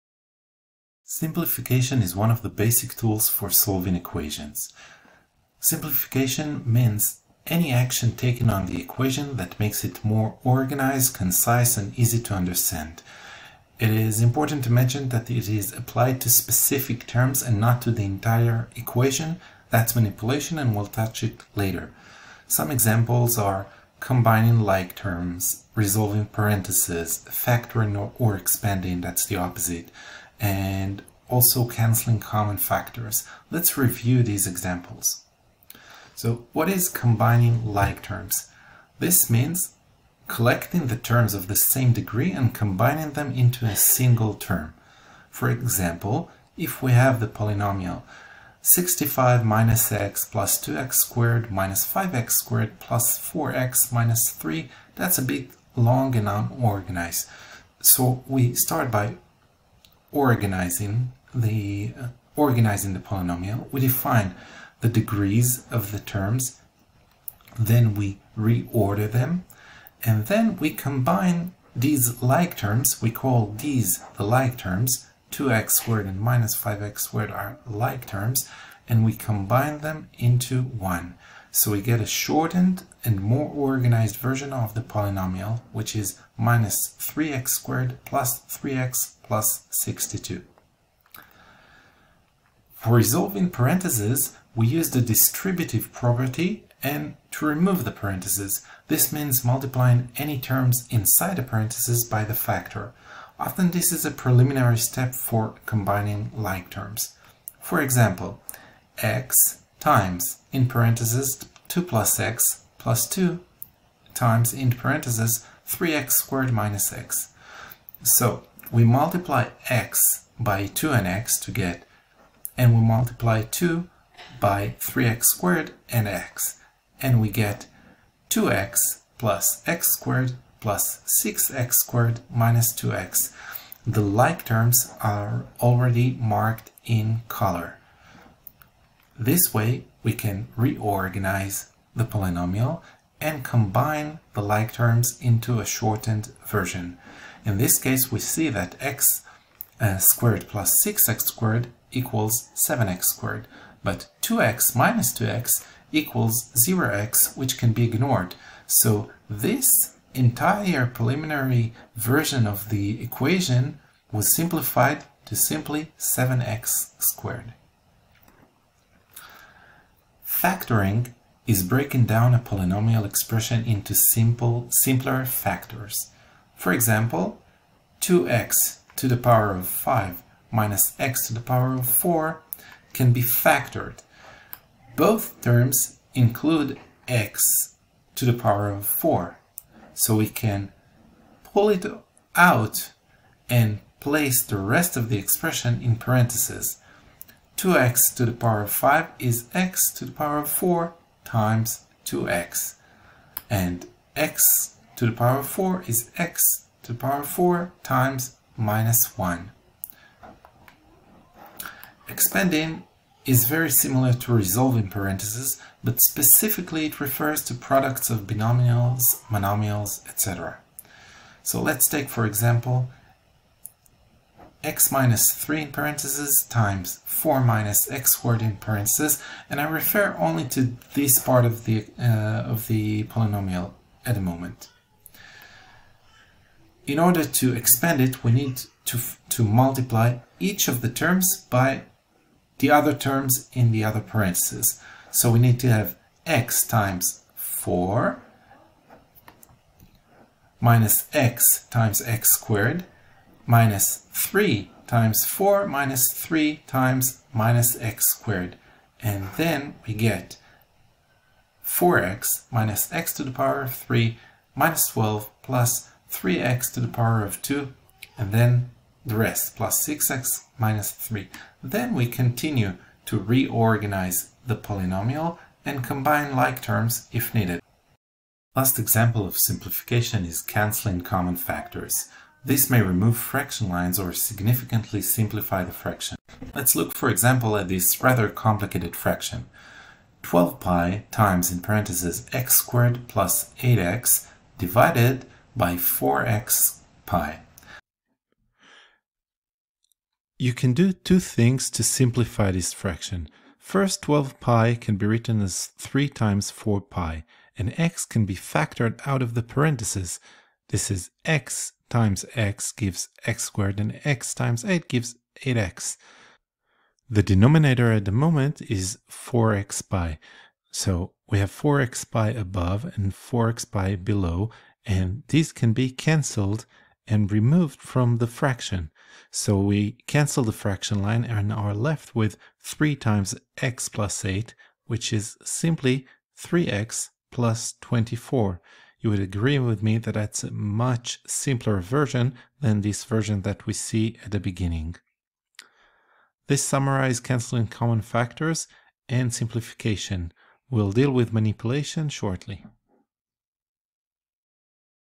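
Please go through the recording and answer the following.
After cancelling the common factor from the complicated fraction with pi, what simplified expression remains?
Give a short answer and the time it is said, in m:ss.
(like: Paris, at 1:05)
3x + 24, at 5:36.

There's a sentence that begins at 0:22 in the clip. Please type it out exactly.
Some examples are combining like terms, resolving parentheses, factoring or, expanding, that's the opposite, and also canceling common factors.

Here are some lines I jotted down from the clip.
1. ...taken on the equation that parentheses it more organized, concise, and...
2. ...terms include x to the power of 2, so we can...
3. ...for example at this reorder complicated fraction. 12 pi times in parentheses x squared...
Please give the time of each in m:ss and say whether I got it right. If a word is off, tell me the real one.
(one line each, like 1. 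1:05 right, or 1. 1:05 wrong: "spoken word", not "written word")
1. 0:08 wrong: "makes", not "parentheses"
2. 3:05 wrong: "4", not "2"
3. 4:46 wrong: "rather", not "reorder".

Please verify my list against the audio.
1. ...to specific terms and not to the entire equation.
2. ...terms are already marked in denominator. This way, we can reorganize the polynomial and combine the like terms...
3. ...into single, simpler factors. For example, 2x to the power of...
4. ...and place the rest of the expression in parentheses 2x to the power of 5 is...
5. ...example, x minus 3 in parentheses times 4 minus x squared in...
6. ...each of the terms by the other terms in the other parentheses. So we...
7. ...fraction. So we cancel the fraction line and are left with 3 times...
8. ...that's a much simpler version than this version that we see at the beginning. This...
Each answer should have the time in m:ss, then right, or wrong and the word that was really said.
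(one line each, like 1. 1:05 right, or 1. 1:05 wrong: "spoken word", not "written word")
1. 0:16 right
2. 2:14 wrong: "color", not "denominator"
3. 2:53 wrong: "simple", not "single"
4. 3:13 right
5. 3:42 right
6. 4:00 right
7. 5:28 right
8. 5:40 right.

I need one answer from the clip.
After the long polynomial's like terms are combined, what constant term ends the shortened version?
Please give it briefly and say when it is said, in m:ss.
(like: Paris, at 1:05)
62, at 1:29.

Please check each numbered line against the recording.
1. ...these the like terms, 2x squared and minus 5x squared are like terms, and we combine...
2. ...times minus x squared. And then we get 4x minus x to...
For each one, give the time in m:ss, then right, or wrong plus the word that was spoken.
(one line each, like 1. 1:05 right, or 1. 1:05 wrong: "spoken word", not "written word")
1. 1:13 right
2. 4:16 right.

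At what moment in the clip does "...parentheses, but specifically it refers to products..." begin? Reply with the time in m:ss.
3:34.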